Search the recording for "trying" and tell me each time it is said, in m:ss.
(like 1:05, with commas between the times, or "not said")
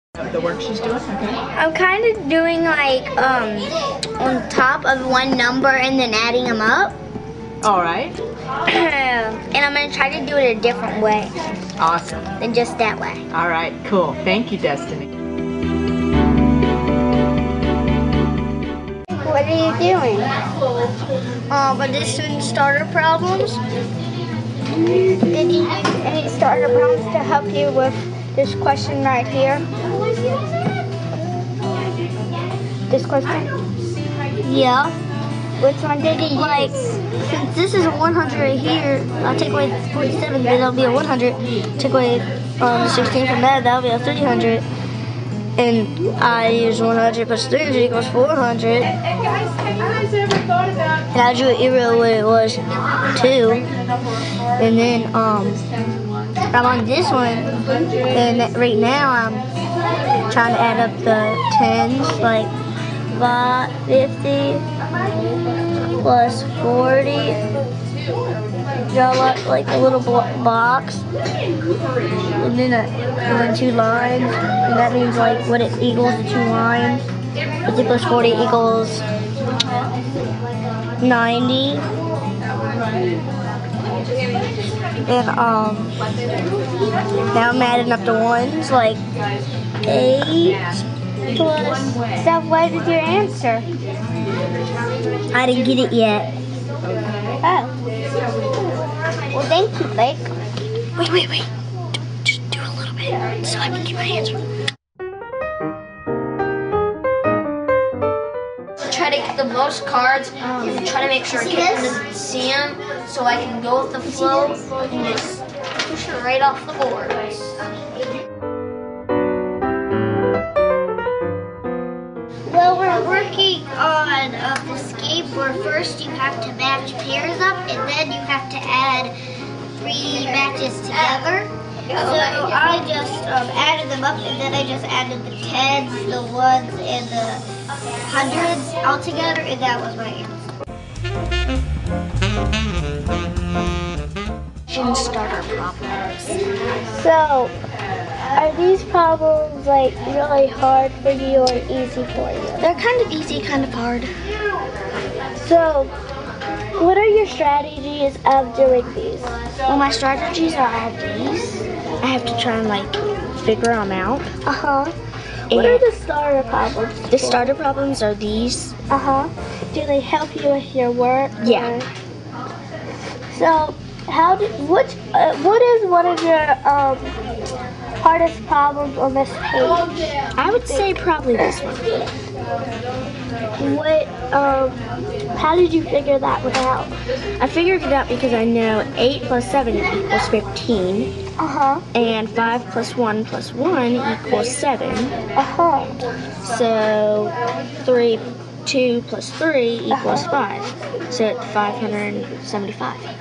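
1:00.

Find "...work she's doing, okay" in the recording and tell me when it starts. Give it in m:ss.
0:00.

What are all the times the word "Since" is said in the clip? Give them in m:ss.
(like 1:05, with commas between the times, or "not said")
0:36.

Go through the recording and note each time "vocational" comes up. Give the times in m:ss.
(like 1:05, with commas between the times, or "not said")
not said.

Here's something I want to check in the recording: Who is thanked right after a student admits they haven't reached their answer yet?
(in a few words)
Blake.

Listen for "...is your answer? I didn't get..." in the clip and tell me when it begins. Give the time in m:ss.
1:32.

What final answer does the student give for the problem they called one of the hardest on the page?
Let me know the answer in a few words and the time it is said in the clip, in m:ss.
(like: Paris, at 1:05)
575, at 3:21.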